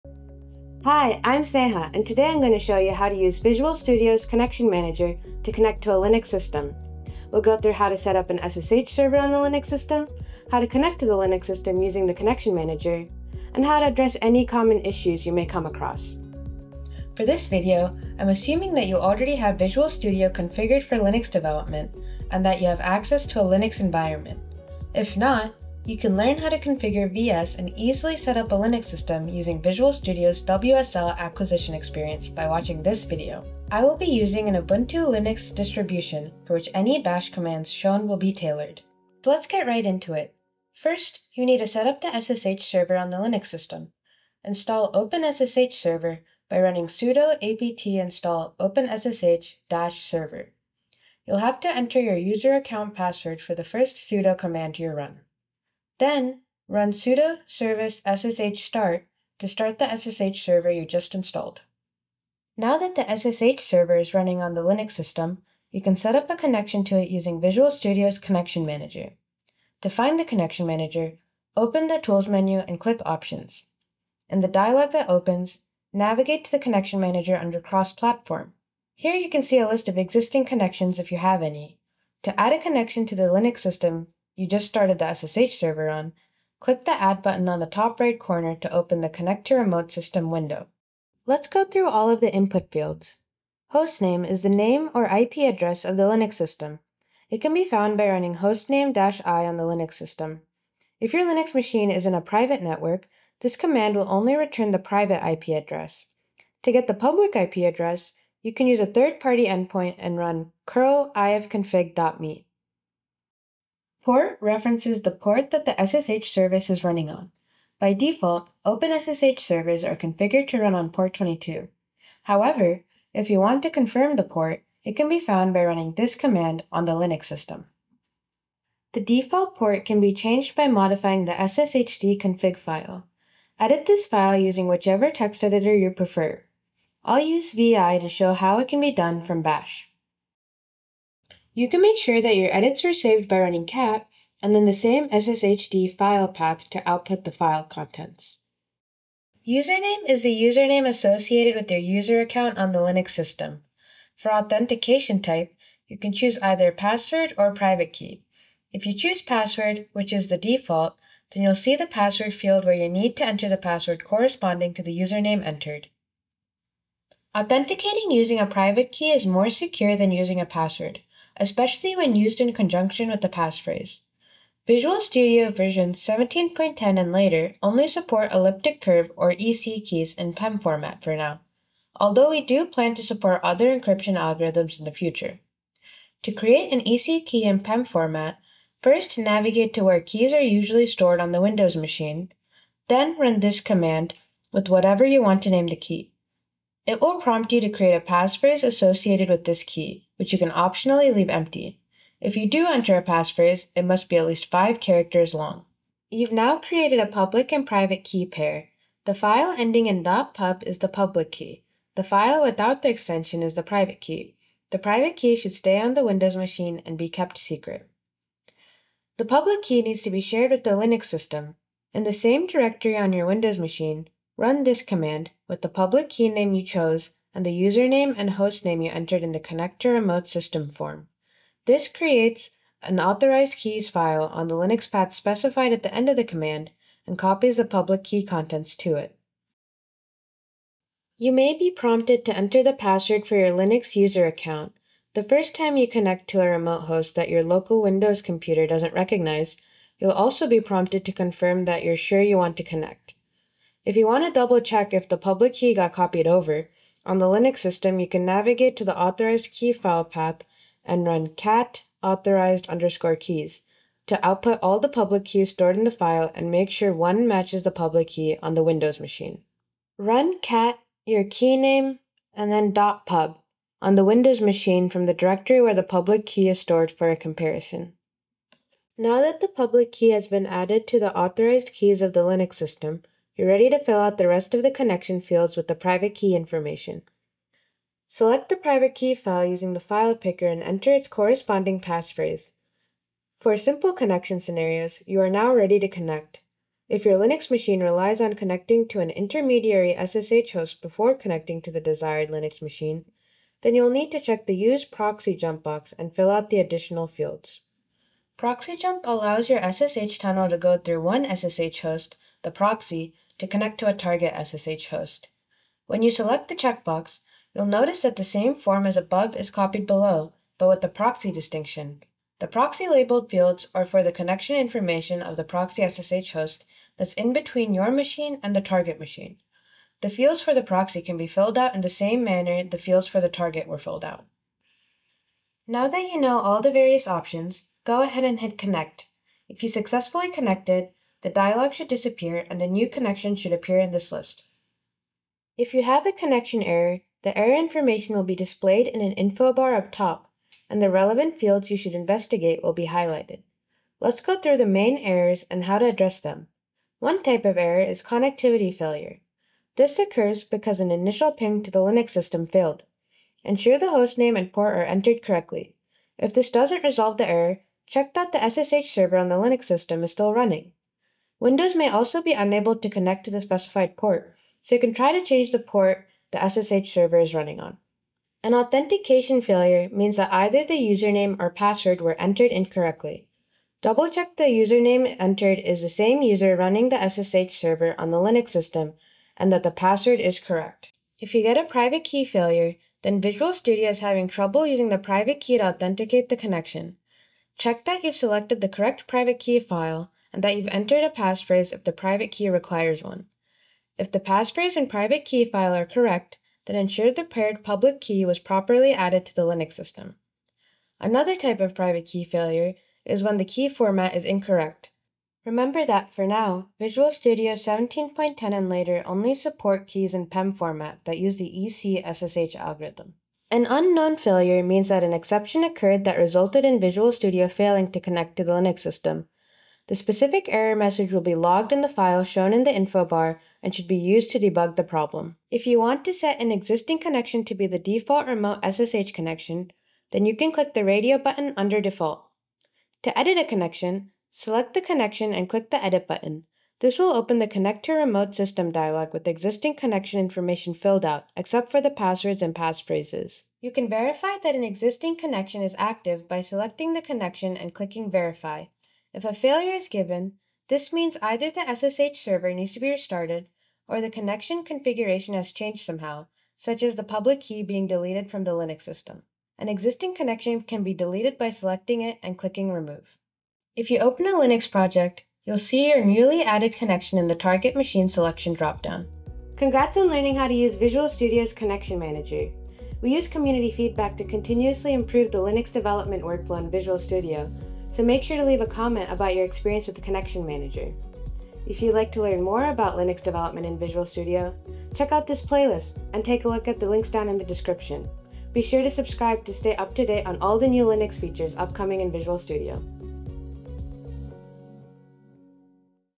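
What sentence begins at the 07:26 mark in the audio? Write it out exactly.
This will open the Connect to Remote System dialog with existing connection information filled out, except for the passwords and passphrases.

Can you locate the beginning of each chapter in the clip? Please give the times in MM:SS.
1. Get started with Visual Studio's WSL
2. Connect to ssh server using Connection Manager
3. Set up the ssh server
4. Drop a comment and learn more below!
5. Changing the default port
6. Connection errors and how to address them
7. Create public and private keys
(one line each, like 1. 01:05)
1. 00:17
2. 01:02
3. 00:39
4. 07:57
5. 02:08
6. 05:45
7. 03:06.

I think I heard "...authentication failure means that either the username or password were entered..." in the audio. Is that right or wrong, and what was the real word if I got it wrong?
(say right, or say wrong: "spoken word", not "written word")
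right.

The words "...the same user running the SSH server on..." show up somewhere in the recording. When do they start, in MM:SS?
06:25.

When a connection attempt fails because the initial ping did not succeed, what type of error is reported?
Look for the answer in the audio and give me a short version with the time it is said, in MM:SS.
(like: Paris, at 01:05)
Connectivity failure, at 05:58.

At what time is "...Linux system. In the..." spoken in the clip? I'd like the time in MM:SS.
03:40.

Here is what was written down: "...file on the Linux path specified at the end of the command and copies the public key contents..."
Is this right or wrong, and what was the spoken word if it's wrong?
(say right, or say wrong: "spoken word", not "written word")
right.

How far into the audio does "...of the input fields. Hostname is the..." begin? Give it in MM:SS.
01:32.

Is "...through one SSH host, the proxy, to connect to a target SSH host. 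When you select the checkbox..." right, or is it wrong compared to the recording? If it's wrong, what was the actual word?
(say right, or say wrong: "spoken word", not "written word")
right.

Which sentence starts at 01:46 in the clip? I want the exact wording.
To get the public IP address, you can use a third-party endpoint and run curl ifconfig.me.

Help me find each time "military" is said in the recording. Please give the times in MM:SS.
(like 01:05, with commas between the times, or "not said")
not said.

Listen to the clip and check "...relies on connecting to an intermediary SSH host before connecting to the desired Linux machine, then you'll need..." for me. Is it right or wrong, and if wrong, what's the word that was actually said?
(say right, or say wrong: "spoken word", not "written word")
right.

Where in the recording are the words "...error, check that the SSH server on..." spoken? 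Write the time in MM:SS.
06:07.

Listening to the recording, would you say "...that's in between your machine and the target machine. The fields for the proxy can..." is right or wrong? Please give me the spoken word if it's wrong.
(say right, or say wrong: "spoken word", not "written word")
right.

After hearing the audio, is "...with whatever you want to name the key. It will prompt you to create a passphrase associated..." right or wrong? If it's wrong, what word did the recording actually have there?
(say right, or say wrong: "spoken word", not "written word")
right.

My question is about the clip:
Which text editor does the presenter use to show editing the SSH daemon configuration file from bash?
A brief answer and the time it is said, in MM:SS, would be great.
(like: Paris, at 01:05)
VI, at 02:17.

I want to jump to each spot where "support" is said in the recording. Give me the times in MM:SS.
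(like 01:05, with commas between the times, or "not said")
02:57, 03:03, 06:59.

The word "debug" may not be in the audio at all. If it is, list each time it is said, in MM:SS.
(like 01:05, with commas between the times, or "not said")
07:14.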